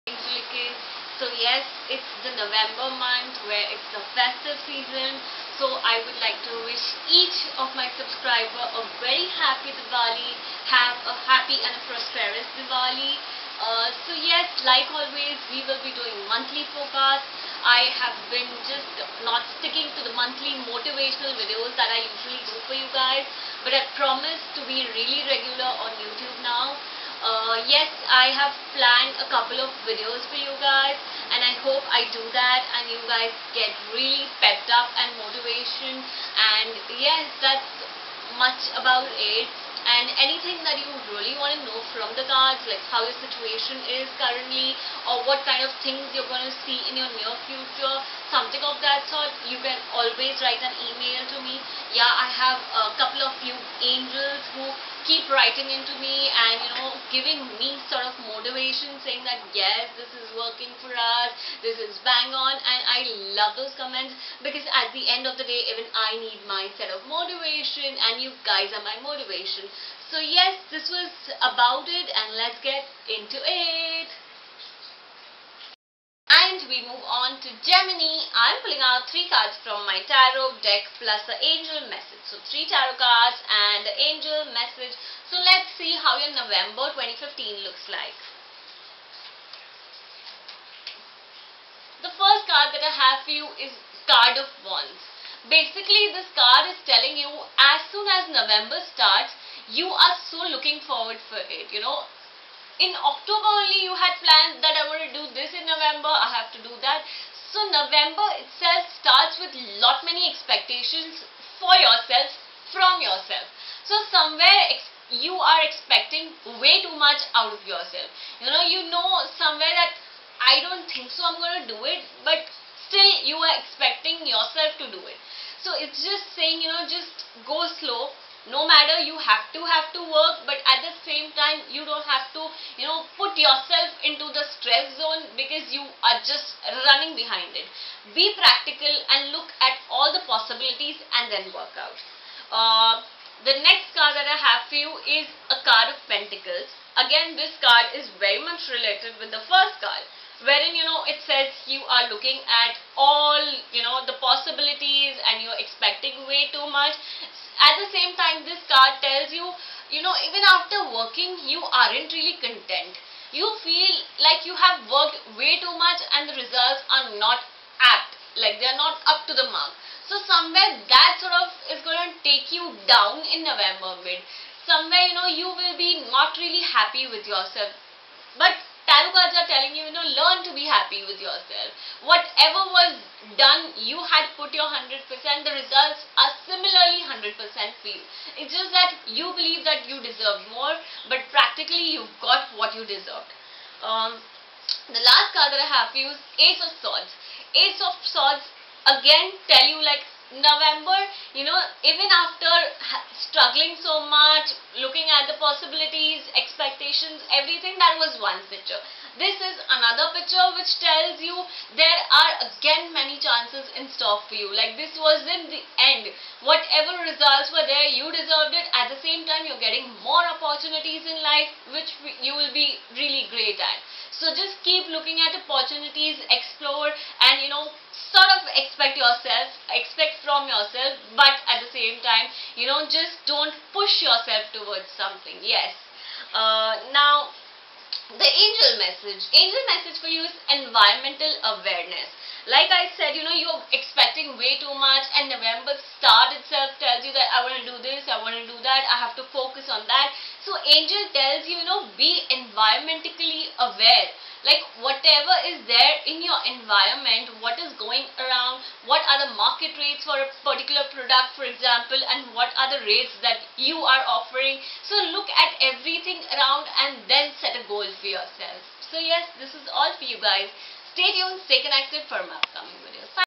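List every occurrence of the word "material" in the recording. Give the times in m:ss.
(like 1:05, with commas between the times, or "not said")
not said.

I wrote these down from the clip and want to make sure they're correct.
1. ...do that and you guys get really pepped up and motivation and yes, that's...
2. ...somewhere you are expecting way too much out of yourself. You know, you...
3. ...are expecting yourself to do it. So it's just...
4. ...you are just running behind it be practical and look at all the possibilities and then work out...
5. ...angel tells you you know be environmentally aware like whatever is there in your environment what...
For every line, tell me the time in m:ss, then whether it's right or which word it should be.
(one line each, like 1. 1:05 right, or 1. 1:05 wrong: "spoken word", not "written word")
1. 0:32 right
2. 1:54 right
3. 2:03 right
4. 2:15 right
5. 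4:10 right.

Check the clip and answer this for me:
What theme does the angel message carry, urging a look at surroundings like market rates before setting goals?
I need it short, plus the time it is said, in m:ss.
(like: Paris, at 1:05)
Environmental awareness, at 4:00.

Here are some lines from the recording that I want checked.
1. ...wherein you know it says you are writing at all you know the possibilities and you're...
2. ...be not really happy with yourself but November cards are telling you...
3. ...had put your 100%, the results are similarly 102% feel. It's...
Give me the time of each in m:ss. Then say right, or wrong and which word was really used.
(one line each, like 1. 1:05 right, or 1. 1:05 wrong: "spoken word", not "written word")
1. 2:30 wrong: "looking", not "writing"
2. 2:55 wrong: "Tarot", not "November"
3. 3:04 wrong: "100", not "102".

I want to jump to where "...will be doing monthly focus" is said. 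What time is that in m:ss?
0:15.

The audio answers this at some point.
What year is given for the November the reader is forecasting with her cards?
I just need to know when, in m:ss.
1:26.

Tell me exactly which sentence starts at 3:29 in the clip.
This is another picture which tells you there are again many chances in store for you.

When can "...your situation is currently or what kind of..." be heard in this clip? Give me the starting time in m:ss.
0:43.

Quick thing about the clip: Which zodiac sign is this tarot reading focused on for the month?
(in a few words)
Gemini.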